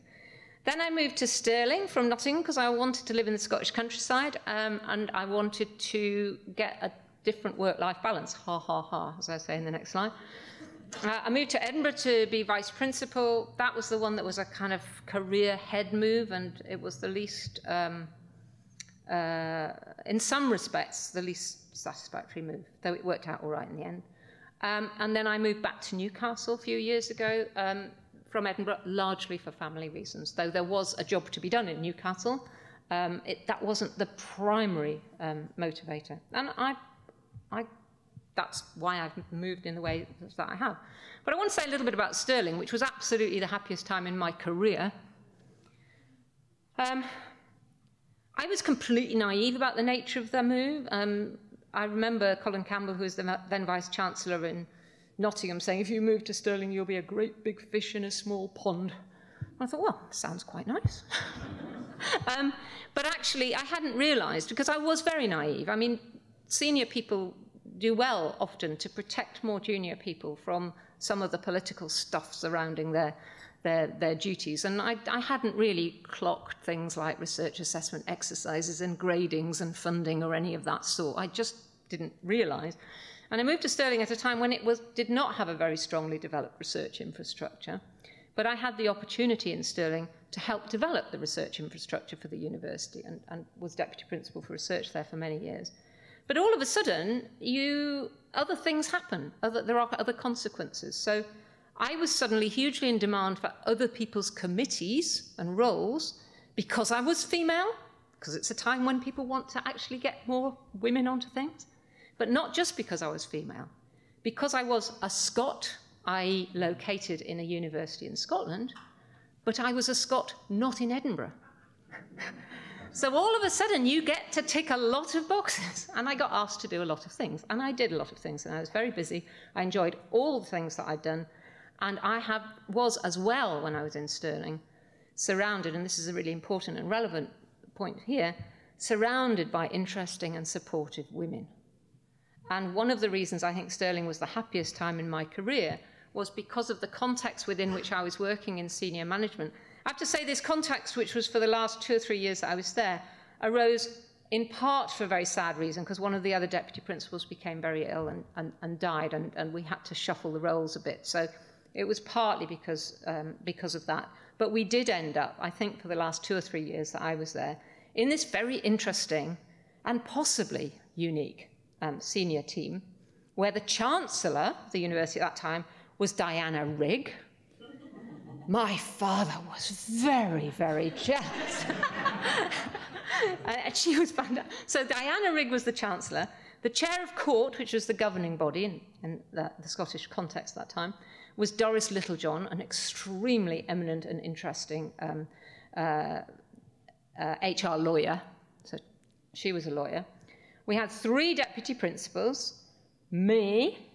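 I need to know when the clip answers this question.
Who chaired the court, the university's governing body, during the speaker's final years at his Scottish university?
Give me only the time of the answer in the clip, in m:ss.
3:11.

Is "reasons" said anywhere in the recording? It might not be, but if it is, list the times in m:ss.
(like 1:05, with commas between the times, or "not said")
0:29, 2:23, 2:35.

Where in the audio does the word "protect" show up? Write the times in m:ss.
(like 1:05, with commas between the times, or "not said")
1:08.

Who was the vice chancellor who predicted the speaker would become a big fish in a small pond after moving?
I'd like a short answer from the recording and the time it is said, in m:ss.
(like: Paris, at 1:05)
Colin Campbell, at 0:52.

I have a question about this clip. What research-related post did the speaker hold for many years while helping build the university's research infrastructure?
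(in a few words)
deputy principal for research.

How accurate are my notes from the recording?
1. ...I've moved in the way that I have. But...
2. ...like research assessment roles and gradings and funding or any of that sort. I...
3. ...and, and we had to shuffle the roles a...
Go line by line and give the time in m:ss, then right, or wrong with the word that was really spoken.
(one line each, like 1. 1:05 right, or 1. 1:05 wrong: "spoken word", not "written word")
1. 0:38 right
2. 1:16 wrong: "exercises", not "roles"
3. 2:39 right.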